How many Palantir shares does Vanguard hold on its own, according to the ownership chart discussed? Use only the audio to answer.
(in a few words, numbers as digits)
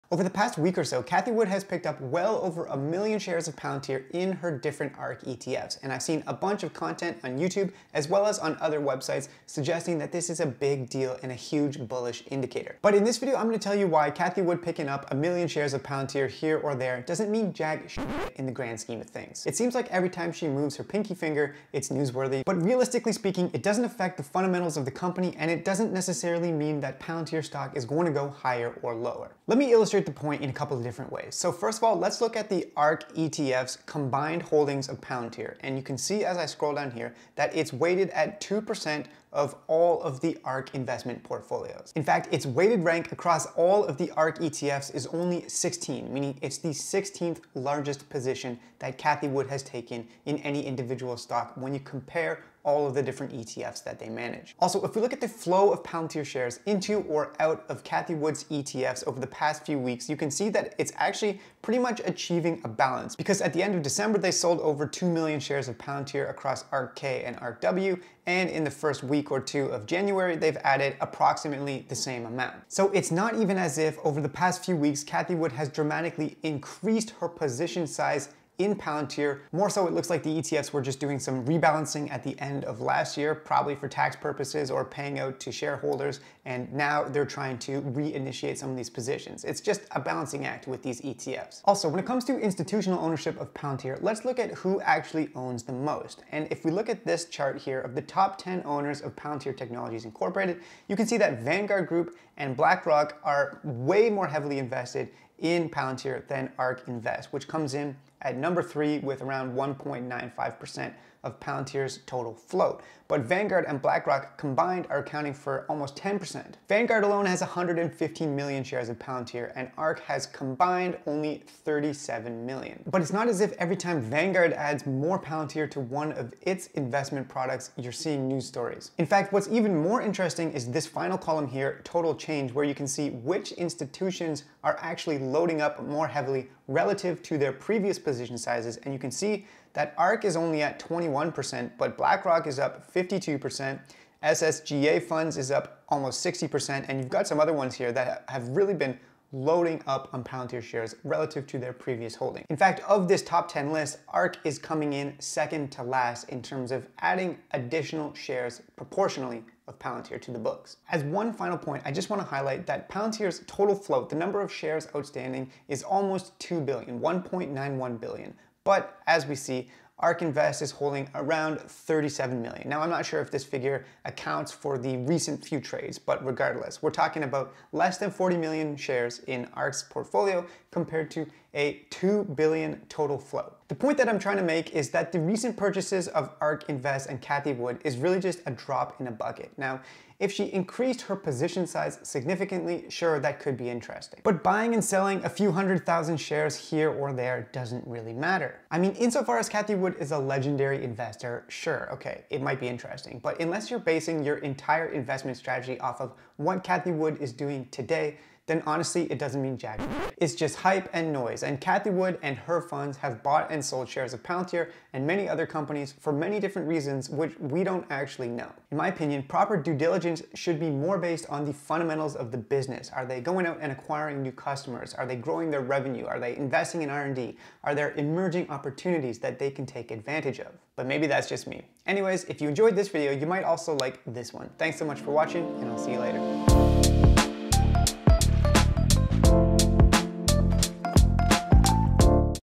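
115 million.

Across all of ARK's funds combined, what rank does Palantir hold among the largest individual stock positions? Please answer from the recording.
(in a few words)
16.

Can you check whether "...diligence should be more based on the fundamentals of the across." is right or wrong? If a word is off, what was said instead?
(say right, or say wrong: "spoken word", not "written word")
wrong: "business", not "across".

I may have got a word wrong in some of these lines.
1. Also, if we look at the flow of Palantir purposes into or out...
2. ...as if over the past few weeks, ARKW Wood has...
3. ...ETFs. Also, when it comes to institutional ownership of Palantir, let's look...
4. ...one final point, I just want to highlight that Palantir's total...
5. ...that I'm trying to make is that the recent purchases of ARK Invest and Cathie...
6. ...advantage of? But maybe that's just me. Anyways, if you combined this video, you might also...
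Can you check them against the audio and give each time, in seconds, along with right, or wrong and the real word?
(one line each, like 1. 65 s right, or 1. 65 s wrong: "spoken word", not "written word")
1. 54 s wrong: "shares", not "purposes"
2. 73 s wrong: "Cathie", not "ARKW"
3. 91 s right
4. 161 s right
5. 183 s right
6. 229 s wrong: "enjoyed", not "combined".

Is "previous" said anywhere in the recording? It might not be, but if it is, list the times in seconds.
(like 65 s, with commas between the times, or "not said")
137 s, 151 s.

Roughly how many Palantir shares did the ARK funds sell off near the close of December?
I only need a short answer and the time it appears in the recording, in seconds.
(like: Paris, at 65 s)
over 2 million, at 64 s.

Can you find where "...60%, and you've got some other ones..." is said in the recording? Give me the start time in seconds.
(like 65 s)
146 s.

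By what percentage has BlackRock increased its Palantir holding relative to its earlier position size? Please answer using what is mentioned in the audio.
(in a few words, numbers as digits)
52%.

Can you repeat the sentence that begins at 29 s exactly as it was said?
Let me illustrate illustrate the point in a couple of different ways.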